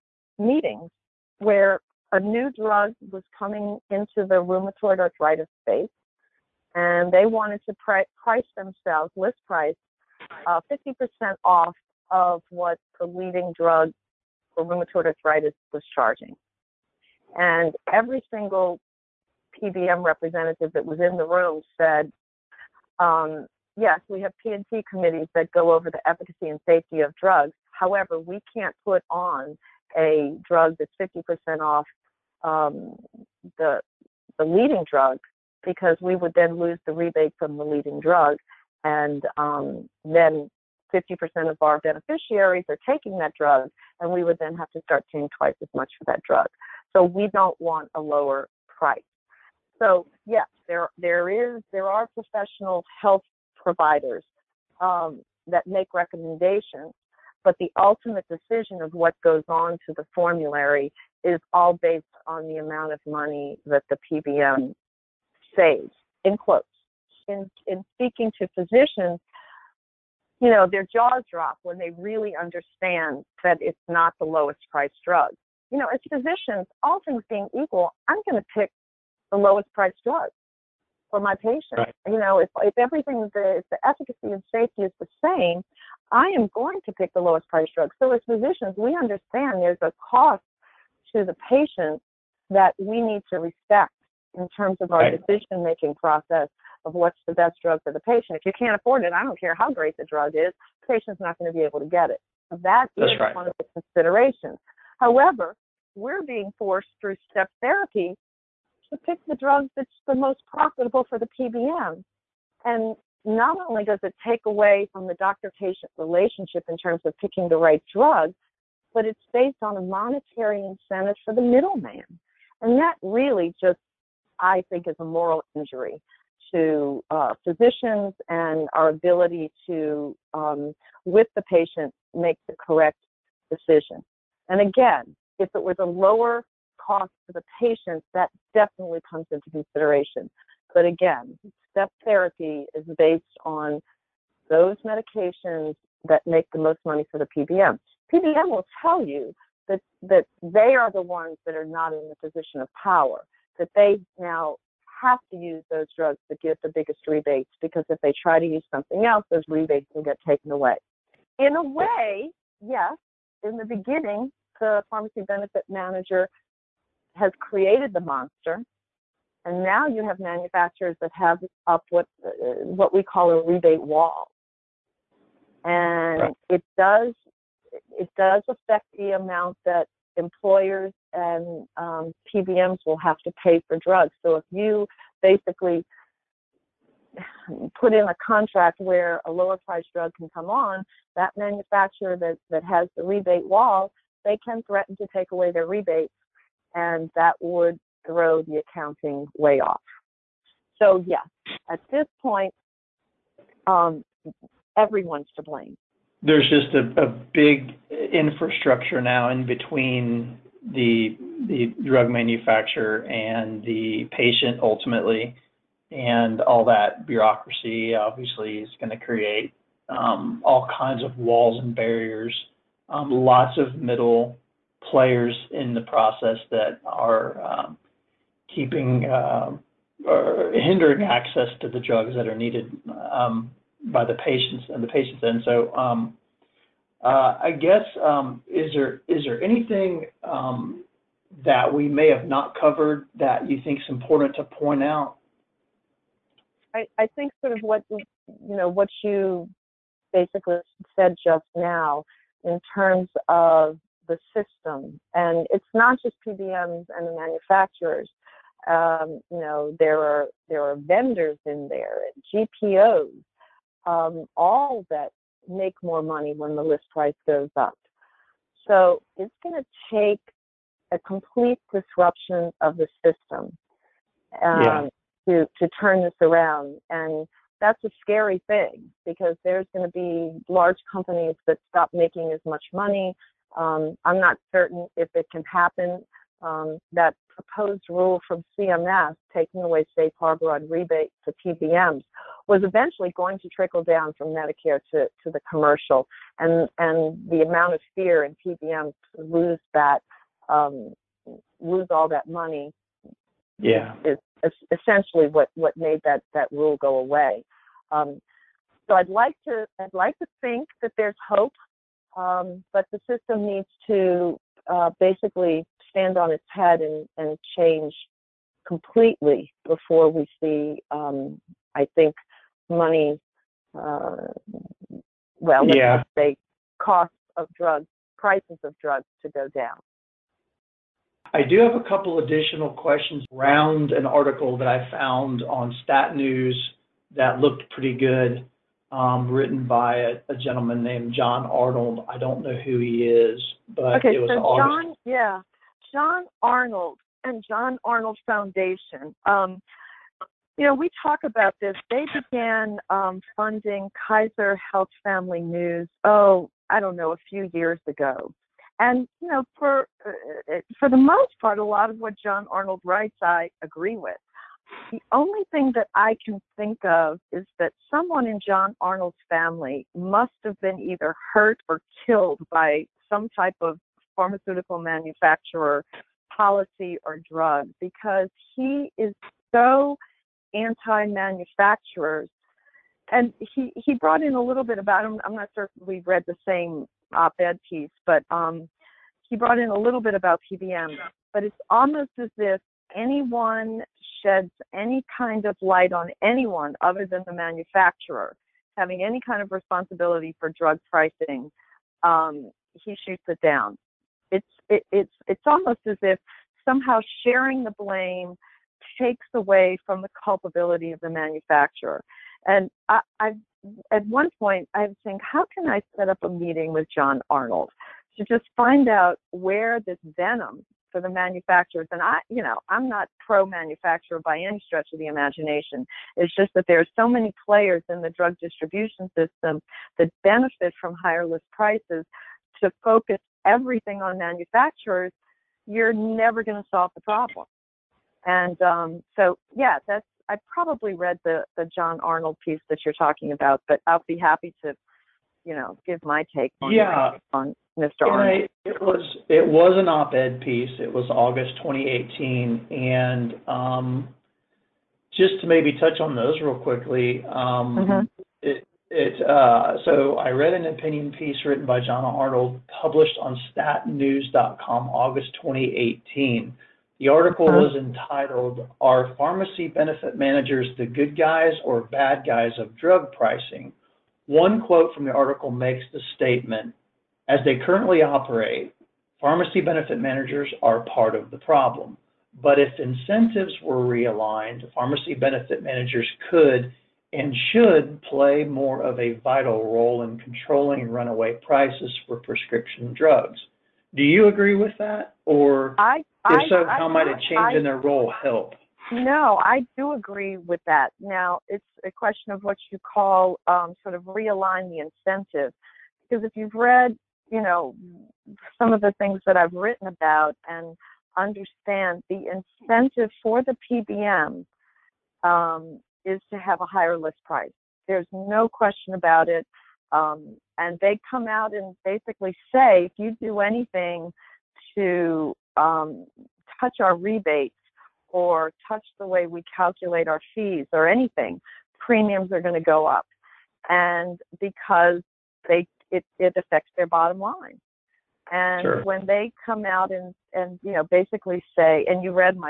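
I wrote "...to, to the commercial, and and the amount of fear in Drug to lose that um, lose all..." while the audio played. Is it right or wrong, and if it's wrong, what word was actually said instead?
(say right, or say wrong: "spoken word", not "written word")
wrong: "PBMs", not "Drug".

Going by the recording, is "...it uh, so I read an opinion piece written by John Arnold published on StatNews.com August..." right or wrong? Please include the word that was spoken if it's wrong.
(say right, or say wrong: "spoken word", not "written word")
right.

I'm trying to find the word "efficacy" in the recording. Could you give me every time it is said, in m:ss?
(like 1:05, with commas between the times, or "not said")
0:26, 1:23.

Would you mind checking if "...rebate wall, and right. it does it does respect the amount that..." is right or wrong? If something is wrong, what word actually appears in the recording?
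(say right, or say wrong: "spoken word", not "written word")
wrong: "affect", not "respect".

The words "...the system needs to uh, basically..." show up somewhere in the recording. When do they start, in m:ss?
5:12.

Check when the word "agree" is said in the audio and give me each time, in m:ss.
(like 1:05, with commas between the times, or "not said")
6:03, 8:14, 8:19.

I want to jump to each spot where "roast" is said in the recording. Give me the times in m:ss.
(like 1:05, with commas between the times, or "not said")
not said.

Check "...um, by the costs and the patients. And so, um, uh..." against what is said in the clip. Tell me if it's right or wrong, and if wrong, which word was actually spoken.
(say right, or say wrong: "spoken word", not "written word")
wrong: "patients", not "costs".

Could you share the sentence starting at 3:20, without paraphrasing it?
So yeah, at this point, um, everyone's to blame.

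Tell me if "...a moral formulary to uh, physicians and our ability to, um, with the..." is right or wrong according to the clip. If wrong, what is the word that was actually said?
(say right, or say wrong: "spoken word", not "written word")
wrong: "injury", not "formulary".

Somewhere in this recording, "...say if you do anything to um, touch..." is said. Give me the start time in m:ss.
8:42.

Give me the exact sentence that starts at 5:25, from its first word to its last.
let's say costs of drugs, prices of drugs to go down.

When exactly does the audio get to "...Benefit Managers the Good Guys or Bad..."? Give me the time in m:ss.
7:49.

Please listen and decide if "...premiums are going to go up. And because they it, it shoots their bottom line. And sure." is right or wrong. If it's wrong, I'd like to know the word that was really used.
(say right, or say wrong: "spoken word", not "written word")
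wrong: "affects", not "shoots".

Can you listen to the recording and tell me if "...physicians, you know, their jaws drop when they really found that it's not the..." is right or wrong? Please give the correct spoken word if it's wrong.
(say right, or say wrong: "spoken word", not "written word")
wrong: "understand", not "found".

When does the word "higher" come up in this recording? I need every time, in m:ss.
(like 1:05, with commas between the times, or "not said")
7:10, 8:36.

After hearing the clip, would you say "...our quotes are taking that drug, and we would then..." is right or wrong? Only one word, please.
wrong.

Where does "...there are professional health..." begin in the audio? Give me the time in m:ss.
0:51.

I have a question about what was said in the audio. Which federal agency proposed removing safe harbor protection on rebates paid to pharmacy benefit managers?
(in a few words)
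CMS.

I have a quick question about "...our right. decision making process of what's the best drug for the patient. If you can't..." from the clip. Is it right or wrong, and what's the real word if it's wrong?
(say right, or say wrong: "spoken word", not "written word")
right.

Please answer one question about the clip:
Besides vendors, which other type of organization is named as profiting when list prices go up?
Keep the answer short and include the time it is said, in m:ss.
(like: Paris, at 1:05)
GPOs, at 4:22.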